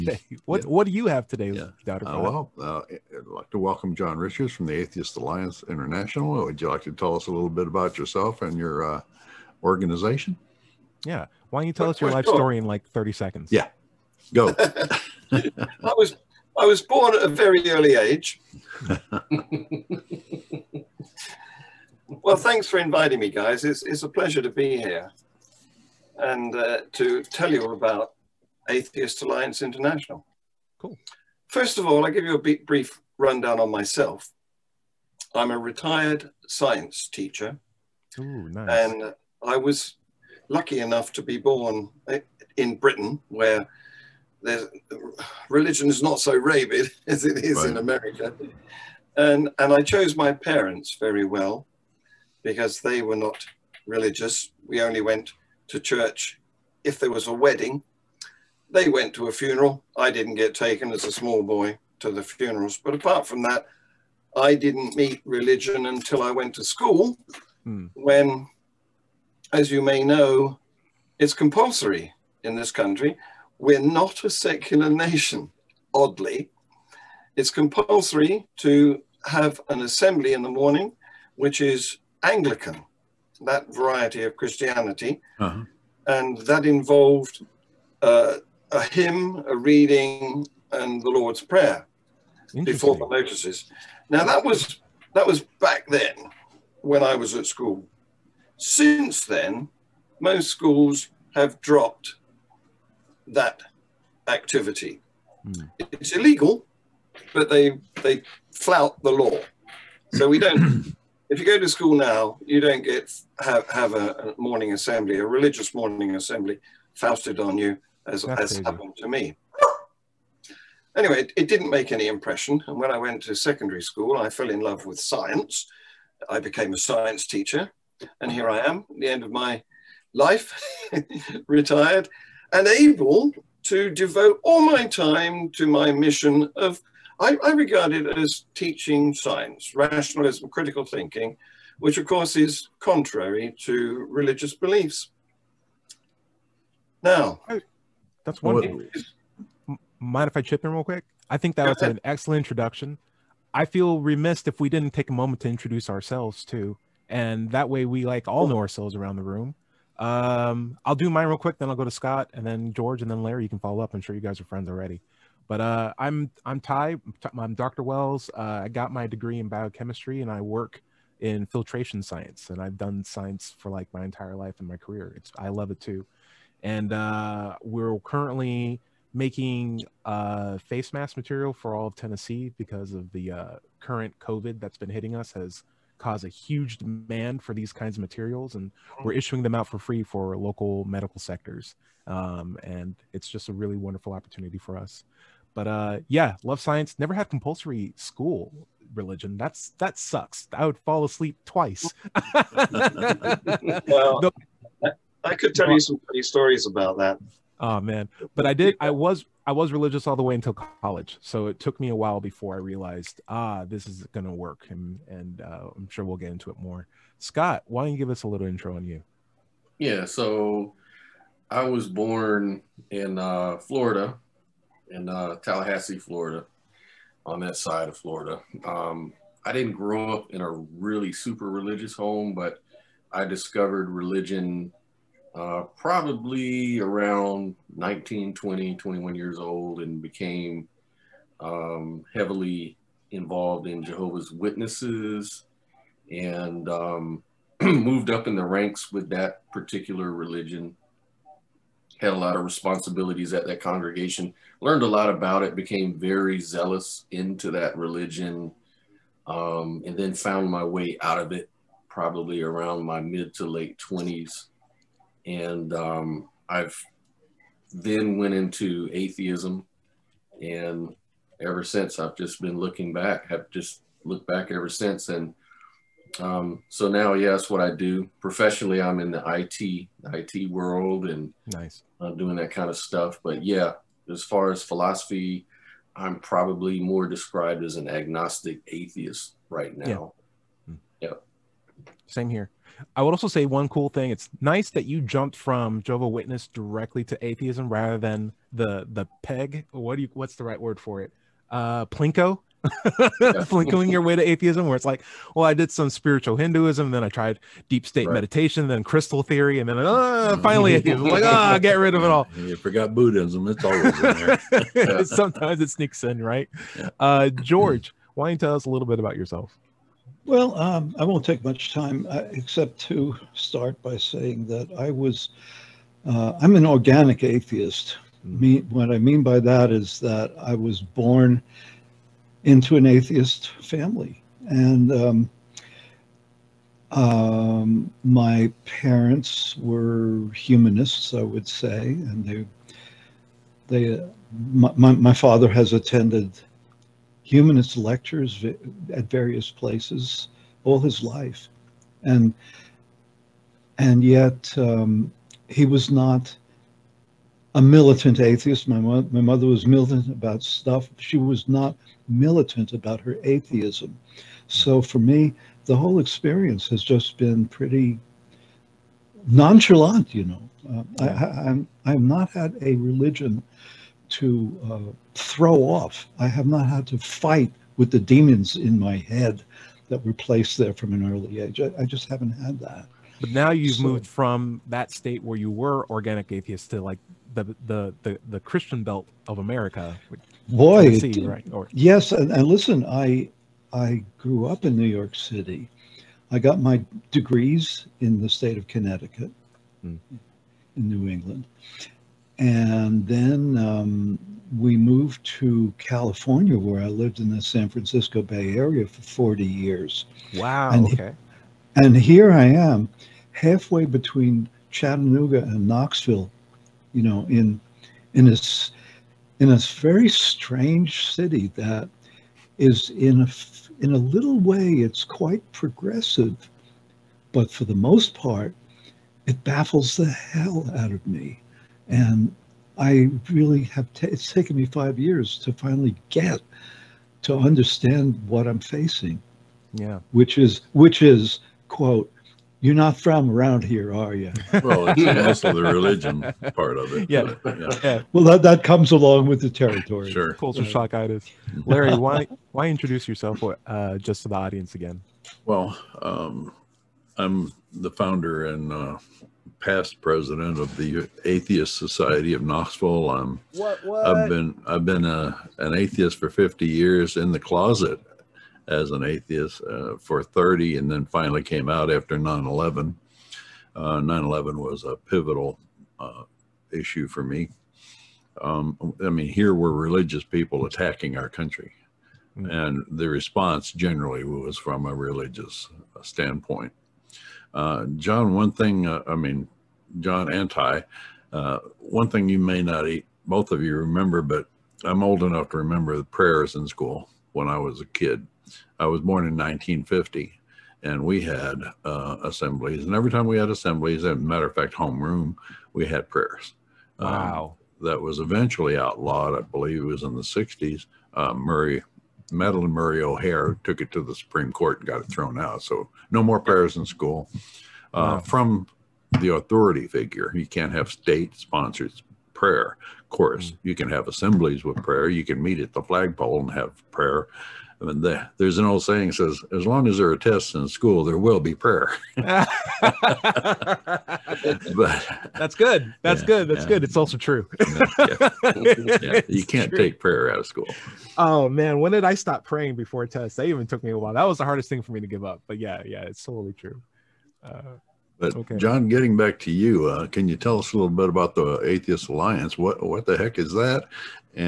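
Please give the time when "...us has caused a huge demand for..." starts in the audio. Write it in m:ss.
3:05.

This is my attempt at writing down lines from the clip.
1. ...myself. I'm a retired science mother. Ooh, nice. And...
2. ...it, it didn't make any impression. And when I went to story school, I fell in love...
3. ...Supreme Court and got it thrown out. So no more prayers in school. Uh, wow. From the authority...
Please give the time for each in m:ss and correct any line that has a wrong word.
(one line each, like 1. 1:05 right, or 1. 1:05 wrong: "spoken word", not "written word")
1. 0:33 wrong: "teacher", not "mother"
2. 2:01 wrong: "secondary", not "story"
3. 8:34 right.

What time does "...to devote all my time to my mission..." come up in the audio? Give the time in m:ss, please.
2:13.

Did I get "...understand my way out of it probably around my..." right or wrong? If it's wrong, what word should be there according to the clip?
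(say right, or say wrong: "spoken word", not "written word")
wrong: "found", not "understand".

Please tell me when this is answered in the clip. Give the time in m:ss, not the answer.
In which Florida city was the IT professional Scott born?
3:45.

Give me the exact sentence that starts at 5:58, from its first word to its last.
My, mo- my mother was militant about stuff.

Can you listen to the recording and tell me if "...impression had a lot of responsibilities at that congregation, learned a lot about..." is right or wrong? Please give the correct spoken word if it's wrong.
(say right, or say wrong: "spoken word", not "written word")
wrong: "religion", not "impression".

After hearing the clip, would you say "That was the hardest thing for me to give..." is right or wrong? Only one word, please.
right.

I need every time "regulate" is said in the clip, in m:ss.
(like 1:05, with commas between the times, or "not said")
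not said.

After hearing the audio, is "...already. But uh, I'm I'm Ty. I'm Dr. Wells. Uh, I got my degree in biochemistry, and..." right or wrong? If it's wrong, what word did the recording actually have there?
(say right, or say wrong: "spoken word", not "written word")
right.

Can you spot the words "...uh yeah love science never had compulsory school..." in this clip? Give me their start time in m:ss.
3:15.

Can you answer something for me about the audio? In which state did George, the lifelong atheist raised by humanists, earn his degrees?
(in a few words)
Connecticut.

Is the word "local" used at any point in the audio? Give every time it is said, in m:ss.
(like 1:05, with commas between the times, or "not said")
3:10.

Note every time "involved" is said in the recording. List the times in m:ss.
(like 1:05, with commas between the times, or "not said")
1:26, 4:03.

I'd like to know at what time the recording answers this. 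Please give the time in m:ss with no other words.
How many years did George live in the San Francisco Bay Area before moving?
6:49.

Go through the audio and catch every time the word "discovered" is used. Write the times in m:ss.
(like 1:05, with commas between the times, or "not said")
3:53.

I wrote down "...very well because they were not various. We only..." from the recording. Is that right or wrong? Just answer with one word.
wrong.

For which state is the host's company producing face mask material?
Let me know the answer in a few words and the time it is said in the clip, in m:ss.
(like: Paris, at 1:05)
Tennessee, at 3:01.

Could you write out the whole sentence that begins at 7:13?
T- it's taken me five years to finally get to understand what I'm facing.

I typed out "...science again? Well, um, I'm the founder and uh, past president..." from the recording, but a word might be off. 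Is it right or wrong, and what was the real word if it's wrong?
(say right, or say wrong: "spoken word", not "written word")
wrong: "audience", not "science".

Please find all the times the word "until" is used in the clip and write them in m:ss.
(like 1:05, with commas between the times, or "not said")
1:05, 3:30.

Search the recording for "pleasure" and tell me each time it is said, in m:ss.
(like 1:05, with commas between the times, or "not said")
0:24.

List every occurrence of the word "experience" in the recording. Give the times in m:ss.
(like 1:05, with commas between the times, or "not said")
6:05.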